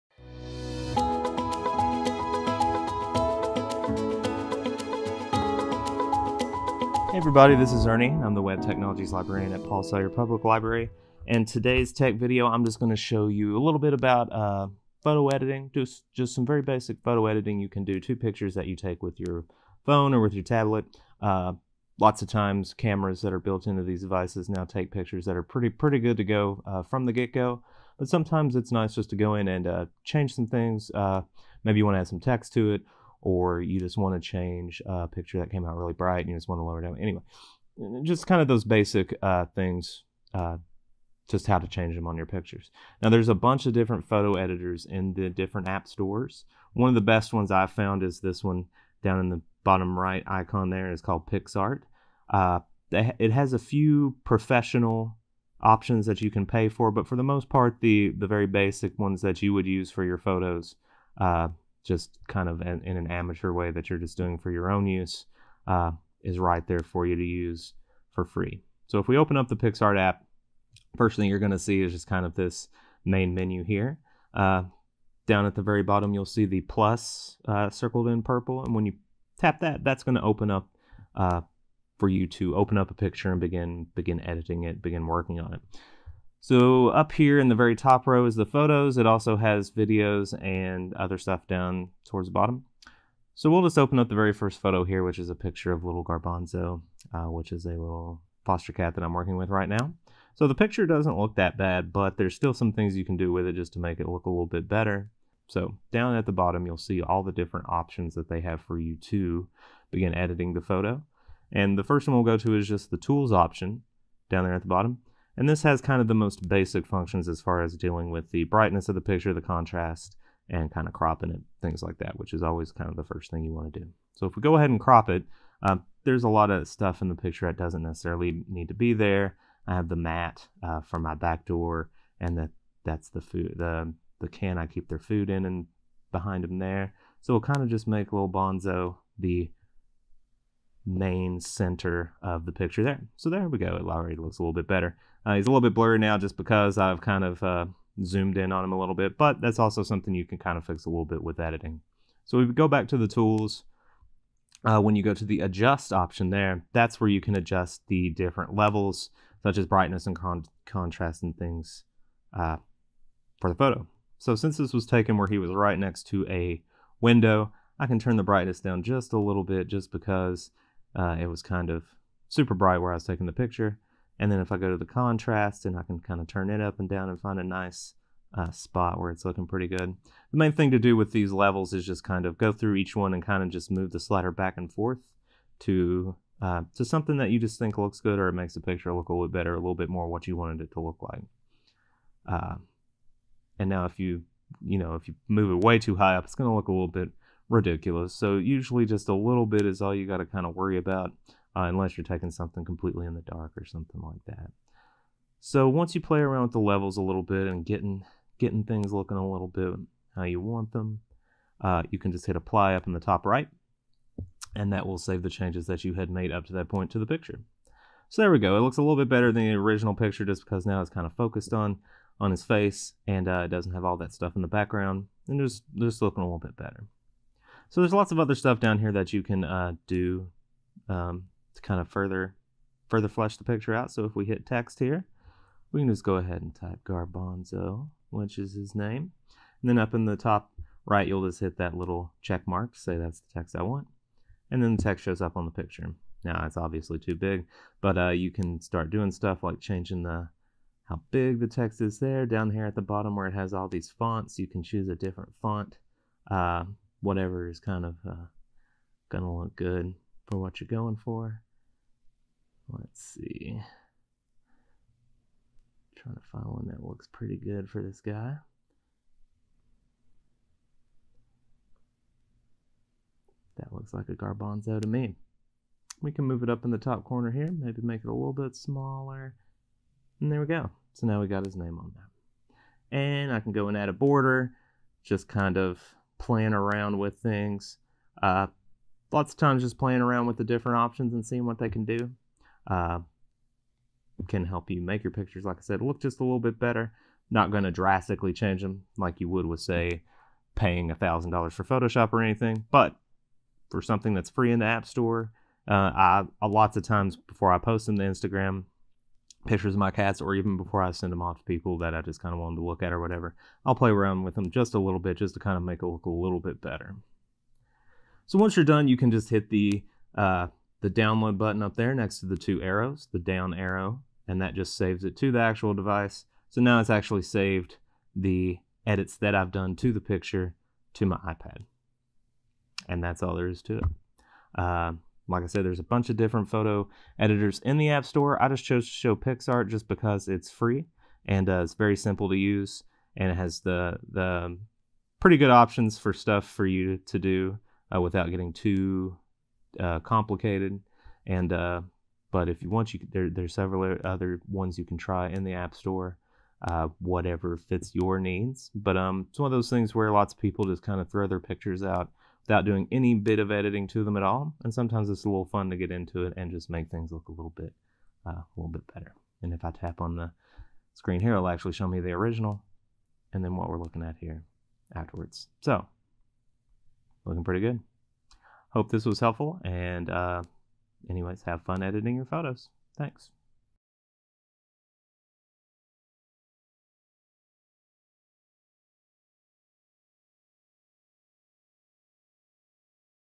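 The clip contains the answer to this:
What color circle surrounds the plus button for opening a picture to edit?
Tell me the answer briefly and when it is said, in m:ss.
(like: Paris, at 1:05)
Purple, at 1:18.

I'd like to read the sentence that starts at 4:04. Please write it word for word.
And then the text shows up on the picture.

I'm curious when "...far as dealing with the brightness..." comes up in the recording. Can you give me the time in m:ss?
1:57.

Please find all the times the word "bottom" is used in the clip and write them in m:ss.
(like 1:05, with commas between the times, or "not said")
0:49, 1:15, 1:32, 1:46, 1:54, 4:12.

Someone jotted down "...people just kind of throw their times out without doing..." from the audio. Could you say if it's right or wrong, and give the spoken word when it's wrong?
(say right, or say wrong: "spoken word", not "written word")
wrong: "pictures", not "times".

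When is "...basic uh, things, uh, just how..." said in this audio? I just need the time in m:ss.
0:38.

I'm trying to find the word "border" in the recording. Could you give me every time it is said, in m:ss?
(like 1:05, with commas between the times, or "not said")
4:43.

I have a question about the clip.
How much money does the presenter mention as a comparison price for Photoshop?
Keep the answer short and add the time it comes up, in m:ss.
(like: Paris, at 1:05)
$1,000, at 5:00.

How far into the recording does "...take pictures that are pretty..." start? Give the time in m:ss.
0:24.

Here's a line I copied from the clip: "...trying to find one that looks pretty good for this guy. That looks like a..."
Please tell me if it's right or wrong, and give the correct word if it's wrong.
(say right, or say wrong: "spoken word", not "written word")
right.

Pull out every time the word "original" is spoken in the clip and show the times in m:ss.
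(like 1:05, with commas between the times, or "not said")
3:39, 6:12.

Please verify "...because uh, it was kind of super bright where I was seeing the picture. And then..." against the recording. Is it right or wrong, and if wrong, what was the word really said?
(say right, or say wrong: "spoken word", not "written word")
wrong: "taking", not "seeing".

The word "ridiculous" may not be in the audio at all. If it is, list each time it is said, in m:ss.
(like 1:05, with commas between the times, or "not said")
3:17.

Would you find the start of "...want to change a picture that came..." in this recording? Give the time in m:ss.
0:33.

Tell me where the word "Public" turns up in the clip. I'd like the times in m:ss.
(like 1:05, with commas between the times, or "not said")
0:10.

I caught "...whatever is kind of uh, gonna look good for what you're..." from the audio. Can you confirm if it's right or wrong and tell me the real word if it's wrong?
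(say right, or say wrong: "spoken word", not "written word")
right.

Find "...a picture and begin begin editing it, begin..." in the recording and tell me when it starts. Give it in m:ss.
1:22.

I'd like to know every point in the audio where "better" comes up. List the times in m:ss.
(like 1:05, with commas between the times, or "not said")
1:44, 2:24, 3:09, 3:39, 3:46, 4:56, 5:16, 6:08.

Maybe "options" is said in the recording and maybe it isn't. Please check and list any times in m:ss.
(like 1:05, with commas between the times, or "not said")
0:55, 1:47, 1:53, 2:35, 4:50, 5:45.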